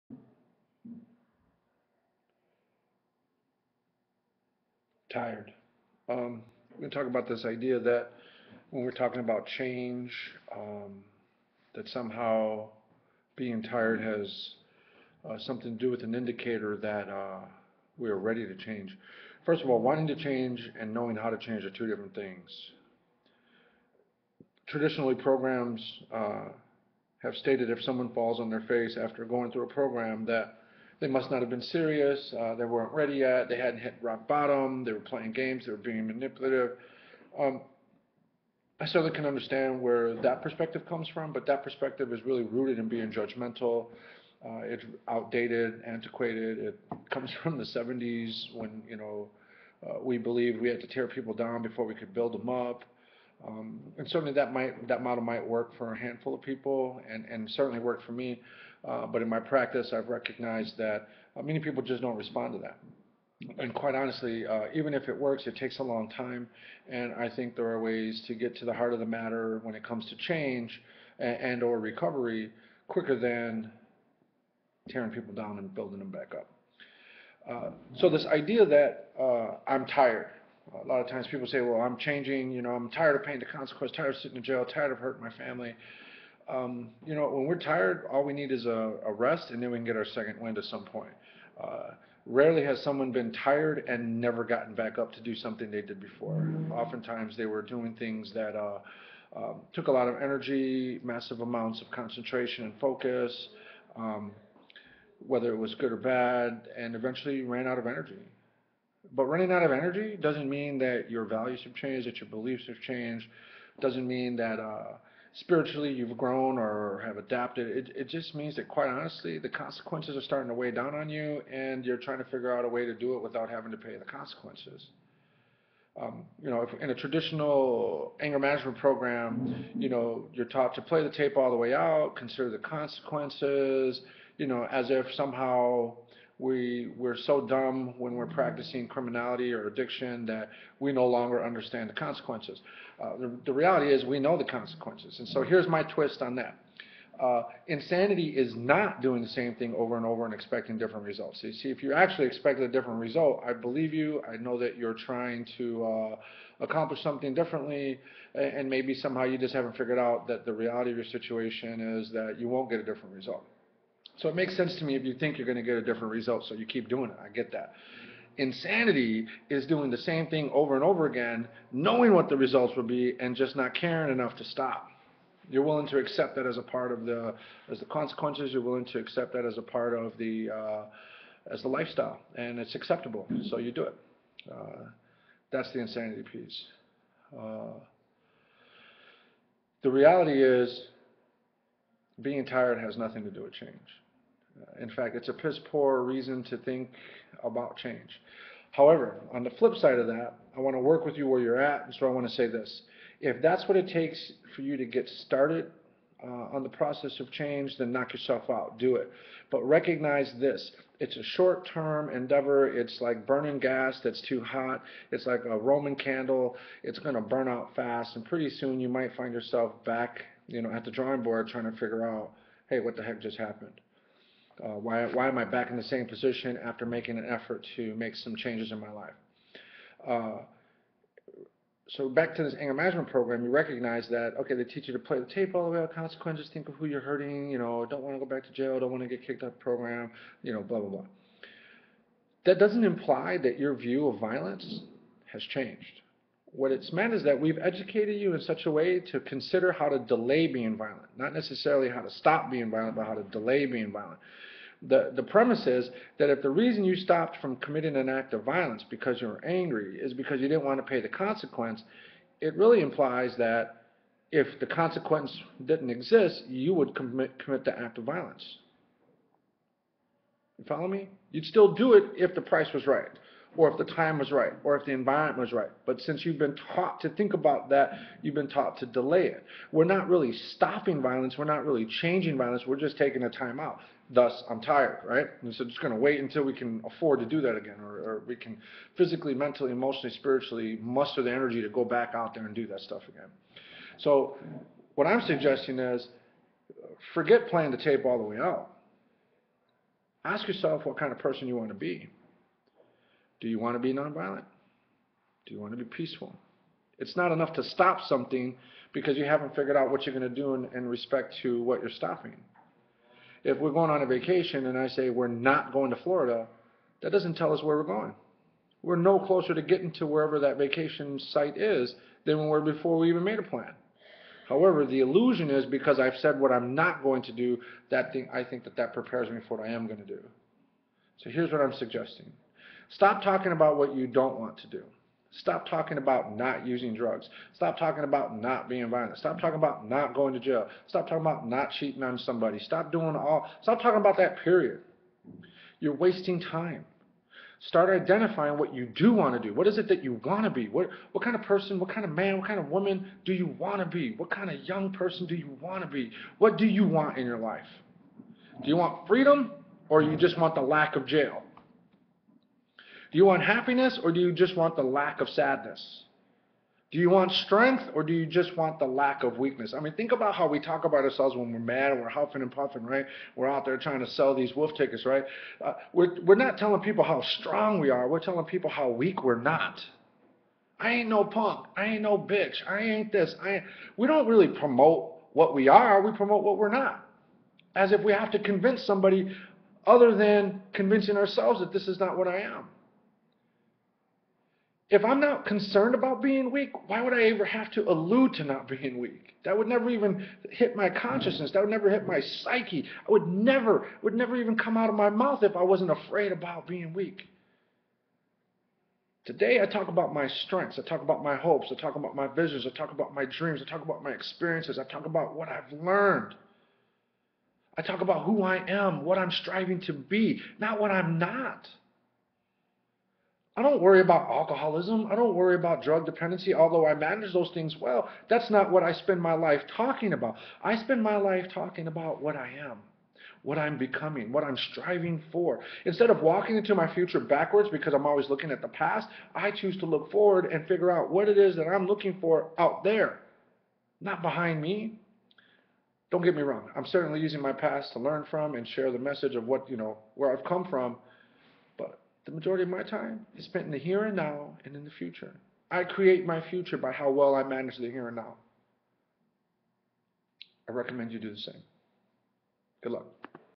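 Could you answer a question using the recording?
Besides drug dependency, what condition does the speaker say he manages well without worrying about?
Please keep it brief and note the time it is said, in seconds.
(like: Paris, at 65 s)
alcoholism, at 424 s.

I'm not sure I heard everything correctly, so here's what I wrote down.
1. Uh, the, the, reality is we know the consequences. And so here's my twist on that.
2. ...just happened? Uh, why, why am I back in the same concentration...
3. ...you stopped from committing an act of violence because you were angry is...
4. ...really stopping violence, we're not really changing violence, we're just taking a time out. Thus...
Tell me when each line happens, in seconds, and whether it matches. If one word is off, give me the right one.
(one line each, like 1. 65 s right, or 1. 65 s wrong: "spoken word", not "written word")
1. 143 s right
2. 223 s wrong: "position", not "concentration"
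3. 256 s right
4. 280 s right.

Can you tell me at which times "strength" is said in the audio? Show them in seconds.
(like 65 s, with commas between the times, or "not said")
367 s, 410 s.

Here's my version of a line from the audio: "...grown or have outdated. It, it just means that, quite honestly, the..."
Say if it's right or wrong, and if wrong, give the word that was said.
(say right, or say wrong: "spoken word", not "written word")
wrong: "adapted", not "outdated".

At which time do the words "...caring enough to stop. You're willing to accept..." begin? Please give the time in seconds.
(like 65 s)
173 s.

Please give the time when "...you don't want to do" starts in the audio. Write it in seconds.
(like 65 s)
333 s.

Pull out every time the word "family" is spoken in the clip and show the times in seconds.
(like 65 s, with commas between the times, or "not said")
85 s.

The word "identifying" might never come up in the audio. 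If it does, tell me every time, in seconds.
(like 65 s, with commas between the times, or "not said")
348 s.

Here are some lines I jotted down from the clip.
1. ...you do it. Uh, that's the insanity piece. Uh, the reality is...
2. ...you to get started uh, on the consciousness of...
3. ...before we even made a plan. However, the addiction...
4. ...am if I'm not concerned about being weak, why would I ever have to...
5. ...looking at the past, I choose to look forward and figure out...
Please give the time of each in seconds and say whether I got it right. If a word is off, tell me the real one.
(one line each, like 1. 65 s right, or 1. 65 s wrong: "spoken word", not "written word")
1. 183 s right
2. 204 s wrong: "process", not "consciousness"
3. 322 s wrong: "illusion", not "addiction"
4. 392 s right
5. 438 s right.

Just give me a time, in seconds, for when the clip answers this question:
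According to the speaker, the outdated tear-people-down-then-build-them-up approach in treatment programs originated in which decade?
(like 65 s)
47 s.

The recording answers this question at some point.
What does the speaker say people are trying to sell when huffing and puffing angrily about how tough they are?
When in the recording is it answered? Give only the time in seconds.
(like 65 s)
374 s.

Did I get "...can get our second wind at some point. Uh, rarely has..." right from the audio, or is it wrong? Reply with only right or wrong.
right.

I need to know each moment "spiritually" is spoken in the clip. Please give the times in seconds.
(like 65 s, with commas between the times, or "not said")
115 s, 290 s.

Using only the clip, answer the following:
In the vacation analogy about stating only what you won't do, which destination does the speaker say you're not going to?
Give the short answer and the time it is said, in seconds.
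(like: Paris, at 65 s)
Florida, at 316 s.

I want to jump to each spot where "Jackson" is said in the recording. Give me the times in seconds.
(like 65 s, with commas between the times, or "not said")
not said.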